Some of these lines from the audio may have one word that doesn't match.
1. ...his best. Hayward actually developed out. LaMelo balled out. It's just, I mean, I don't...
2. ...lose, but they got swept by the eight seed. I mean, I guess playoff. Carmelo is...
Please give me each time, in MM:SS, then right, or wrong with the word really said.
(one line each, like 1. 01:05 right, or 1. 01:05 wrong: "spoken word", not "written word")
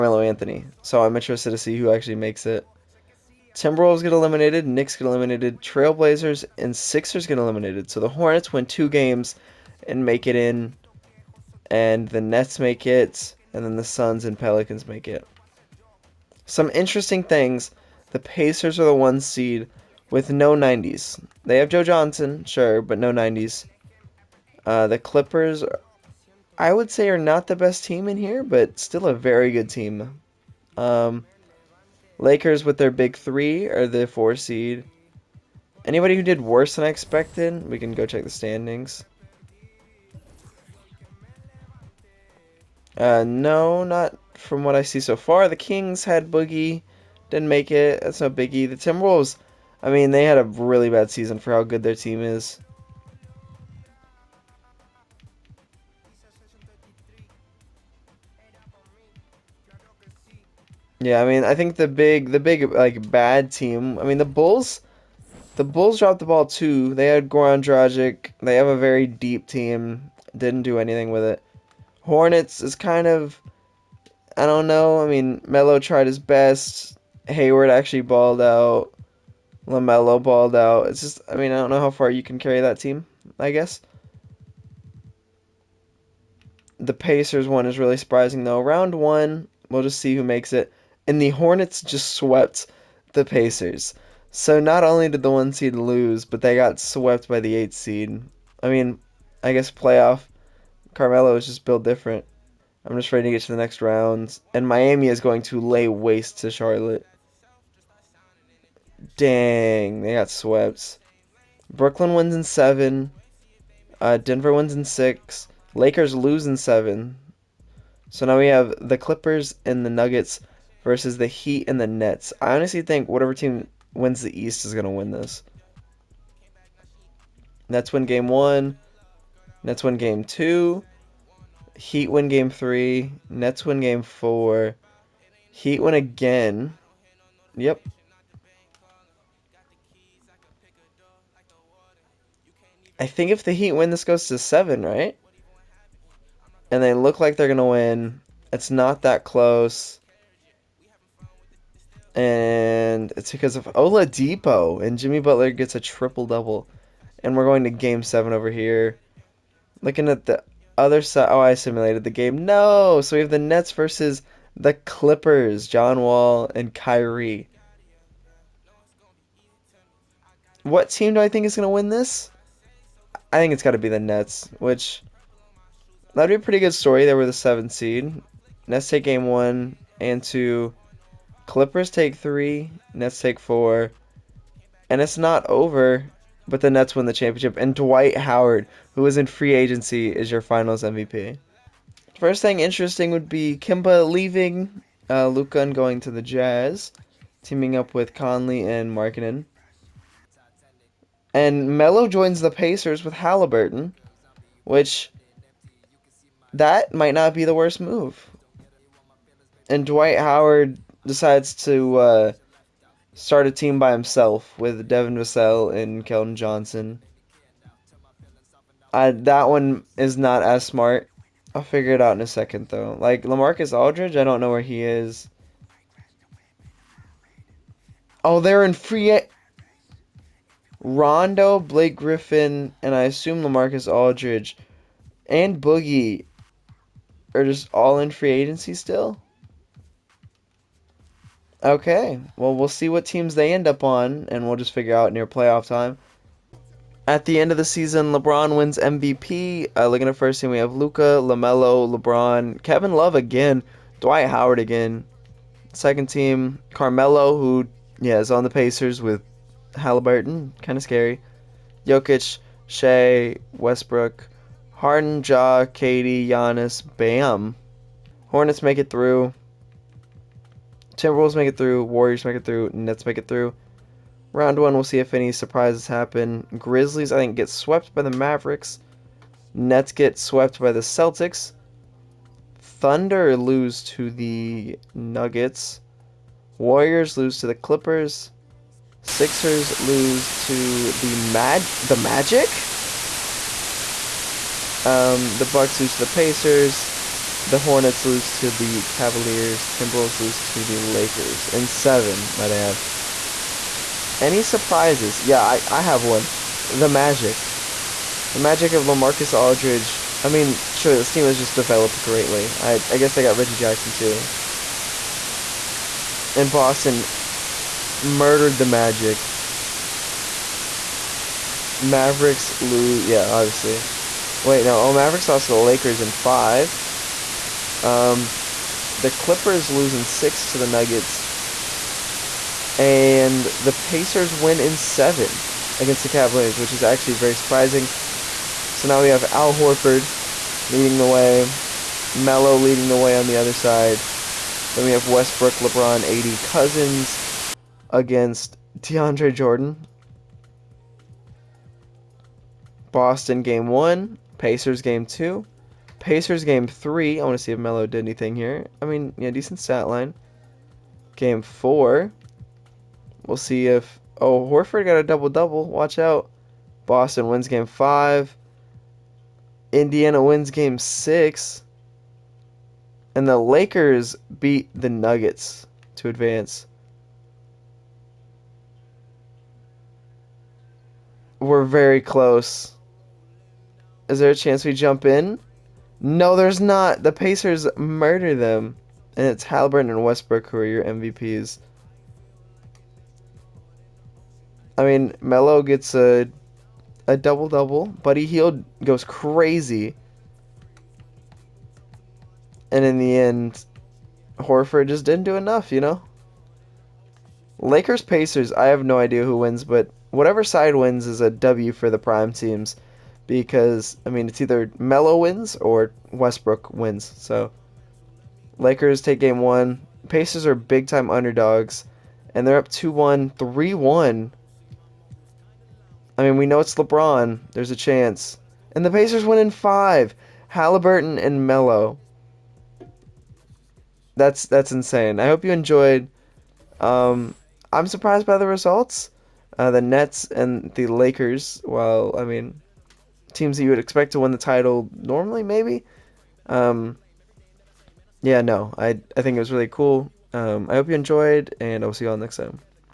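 1. 01:16 wrong: "balled", not "developed"
2. 01:35 right.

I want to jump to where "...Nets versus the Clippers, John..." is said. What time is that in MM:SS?
02:43.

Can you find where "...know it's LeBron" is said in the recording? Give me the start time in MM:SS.
07:06.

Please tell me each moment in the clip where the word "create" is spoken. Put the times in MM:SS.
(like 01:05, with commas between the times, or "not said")
not said.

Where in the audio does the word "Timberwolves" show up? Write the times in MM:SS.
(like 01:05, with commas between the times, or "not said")
00:03, 00:48, 04:30, 04:59.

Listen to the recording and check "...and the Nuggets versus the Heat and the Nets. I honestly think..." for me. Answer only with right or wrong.
right.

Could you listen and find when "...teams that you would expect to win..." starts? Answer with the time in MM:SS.
07:23.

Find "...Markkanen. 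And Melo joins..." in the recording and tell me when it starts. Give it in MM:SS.
03:18.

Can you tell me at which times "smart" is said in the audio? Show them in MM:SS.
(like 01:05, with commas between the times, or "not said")
03:40.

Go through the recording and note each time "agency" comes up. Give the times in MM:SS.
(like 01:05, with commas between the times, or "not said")
03:09, 03:58.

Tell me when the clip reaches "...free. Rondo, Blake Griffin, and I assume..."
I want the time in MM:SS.
03:48.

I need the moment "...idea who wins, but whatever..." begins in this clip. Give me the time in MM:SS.
06:48.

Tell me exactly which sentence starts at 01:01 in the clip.
Yeah, I mean, I think the big, the big like bad team.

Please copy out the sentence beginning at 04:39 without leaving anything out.
Nets get swept by the Celtics.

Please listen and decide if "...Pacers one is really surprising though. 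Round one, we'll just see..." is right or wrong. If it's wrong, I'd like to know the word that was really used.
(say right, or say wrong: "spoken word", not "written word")
right.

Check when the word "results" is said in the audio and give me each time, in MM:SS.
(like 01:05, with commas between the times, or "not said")
07:18.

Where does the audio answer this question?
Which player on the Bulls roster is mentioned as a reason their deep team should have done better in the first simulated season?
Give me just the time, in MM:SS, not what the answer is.
01:07.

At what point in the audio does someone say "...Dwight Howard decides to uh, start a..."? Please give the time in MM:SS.
03:29.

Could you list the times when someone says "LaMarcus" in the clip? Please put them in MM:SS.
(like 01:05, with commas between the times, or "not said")
03:43, 03:53, 05:08.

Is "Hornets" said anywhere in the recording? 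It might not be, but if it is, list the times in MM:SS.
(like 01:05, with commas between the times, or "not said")
00:08, 01:11, 01:31, 04:28, 04:57.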